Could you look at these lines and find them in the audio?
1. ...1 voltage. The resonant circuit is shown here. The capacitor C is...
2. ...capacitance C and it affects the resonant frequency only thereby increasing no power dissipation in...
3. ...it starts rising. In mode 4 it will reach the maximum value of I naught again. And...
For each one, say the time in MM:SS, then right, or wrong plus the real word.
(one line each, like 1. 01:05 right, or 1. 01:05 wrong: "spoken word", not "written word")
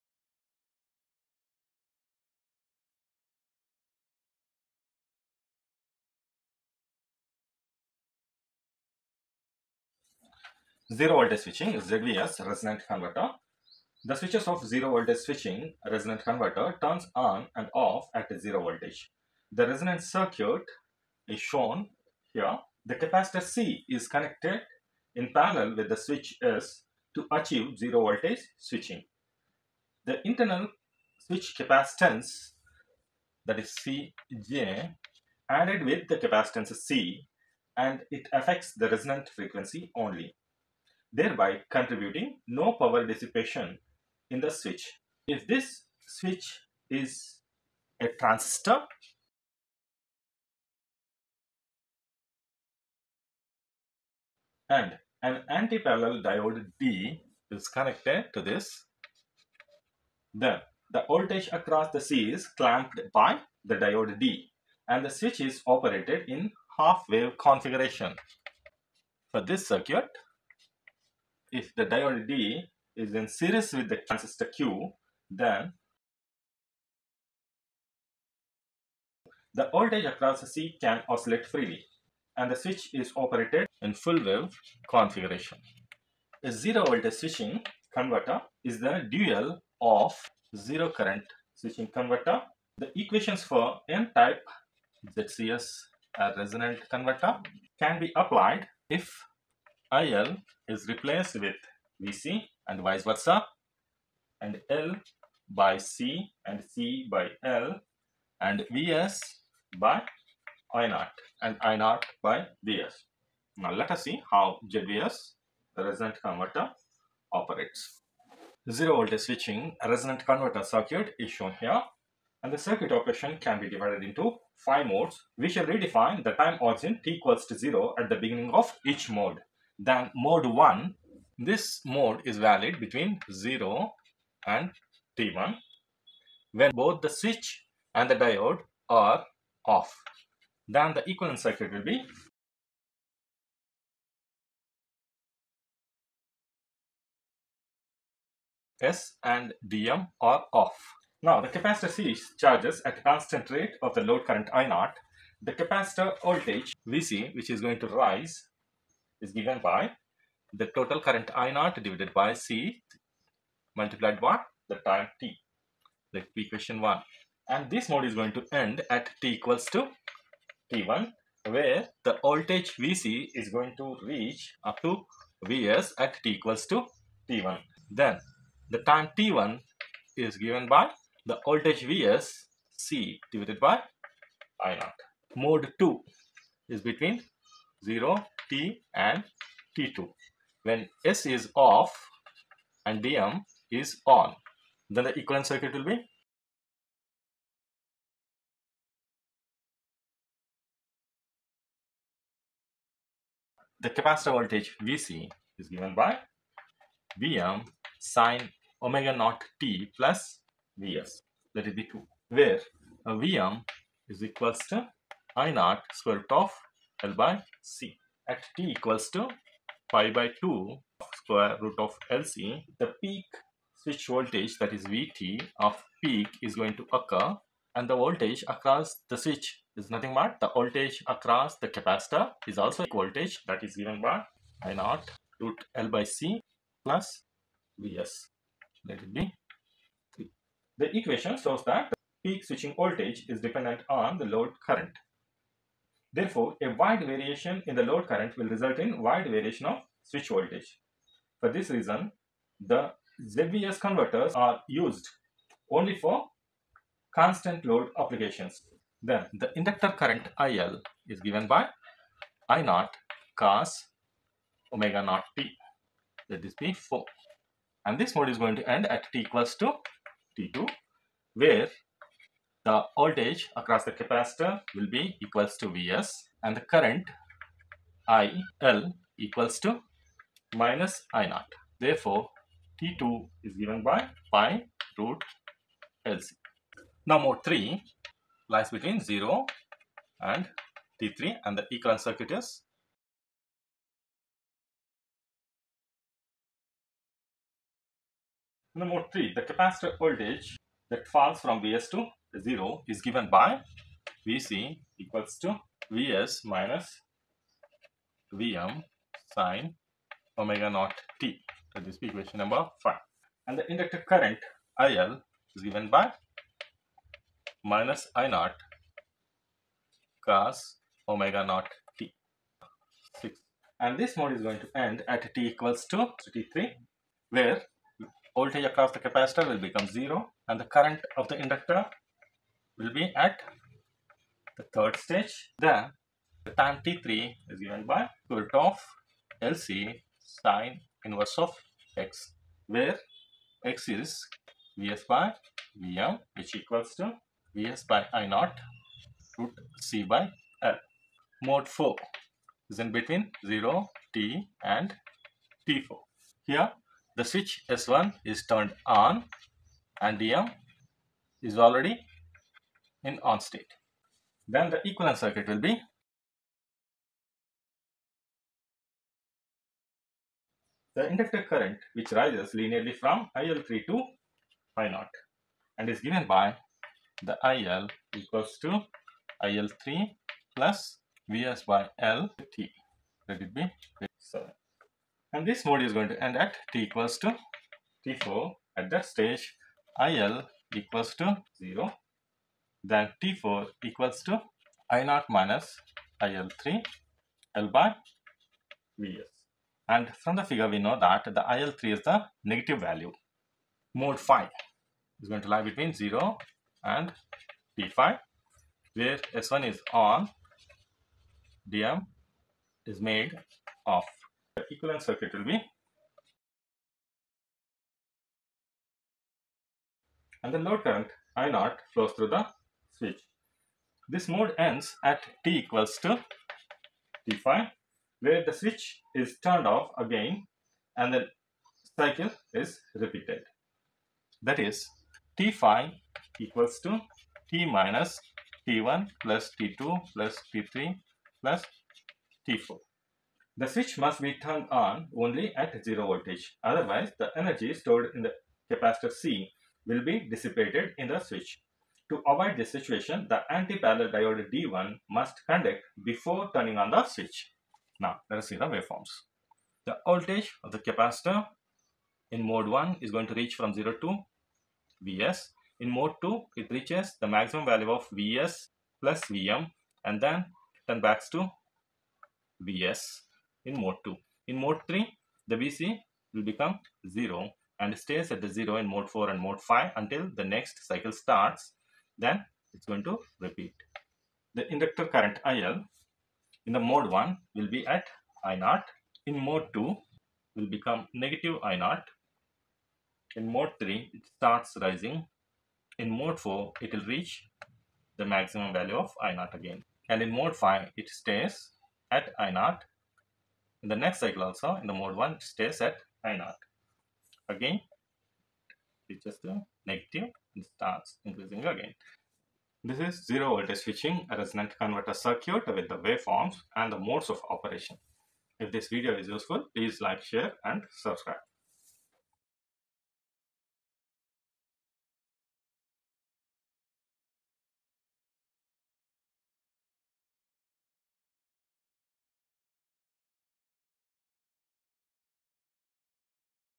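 1. 00:18 wrong: "0", not "1"
2. 00:36 wrong: "contributing", not "increasing"
3. 08:14 right.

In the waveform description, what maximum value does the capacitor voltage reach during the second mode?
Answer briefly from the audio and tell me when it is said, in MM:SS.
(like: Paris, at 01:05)
Vs plus Vm, at 07:48.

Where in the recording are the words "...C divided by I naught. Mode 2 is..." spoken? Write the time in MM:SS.
03:02.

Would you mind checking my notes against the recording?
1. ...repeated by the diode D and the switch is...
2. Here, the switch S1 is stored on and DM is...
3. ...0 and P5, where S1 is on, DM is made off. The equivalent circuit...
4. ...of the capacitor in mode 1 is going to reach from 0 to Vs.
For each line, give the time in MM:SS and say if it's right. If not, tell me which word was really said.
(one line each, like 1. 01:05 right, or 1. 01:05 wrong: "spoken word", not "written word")
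1. 01:02 wrong: "clamped", not "repeated"
2. 05:56 wrong: "turned", not "stored"
3. 06:45 right
4. 07:40 right.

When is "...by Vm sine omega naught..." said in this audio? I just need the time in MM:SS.
03:25.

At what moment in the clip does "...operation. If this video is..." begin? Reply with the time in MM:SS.
08:37.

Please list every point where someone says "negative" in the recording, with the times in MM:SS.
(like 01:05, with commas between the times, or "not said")
06:42, 08:11, 08:29.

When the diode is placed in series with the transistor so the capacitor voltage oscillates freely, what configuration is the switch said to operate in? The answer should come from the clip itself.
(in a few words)
full wave configuration.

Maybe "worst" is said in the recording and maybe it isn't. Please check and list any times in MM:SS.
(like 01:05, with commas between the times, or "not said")
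not said.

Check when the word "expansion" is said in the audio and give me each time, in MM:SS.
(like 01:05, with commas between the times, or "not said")
not said.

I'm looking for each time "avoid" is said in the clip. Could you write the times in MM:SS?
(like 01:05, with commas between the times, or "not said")
07:32.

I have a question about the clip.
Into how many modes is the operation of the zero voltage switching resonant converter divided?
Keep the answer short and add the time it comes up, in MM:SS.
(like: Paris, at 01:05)
5, at 02:04.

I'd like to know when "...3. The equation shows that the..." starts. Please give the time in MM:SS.
04:00.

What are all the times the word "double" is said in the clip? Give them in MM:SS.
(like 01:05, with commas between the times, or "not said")
not said.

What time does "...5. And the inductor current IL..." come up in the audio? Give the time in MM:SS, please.
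05:12.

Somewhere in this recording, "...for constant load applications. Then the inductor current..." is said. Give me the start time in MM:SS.
04:15.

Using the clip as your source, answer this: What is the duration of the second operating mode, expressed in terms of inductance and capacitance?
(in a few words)
pi root LC.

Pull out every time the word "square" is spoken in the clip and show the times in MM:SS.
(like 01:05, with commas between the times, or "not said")
03:35, 03:41.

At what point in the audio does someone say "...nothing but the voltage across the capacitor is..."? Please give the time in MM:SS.
03:49.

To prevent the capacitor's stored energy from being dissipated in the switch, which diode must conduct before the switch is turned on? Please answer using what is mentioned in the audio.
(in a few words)
anti-parallel diode D1.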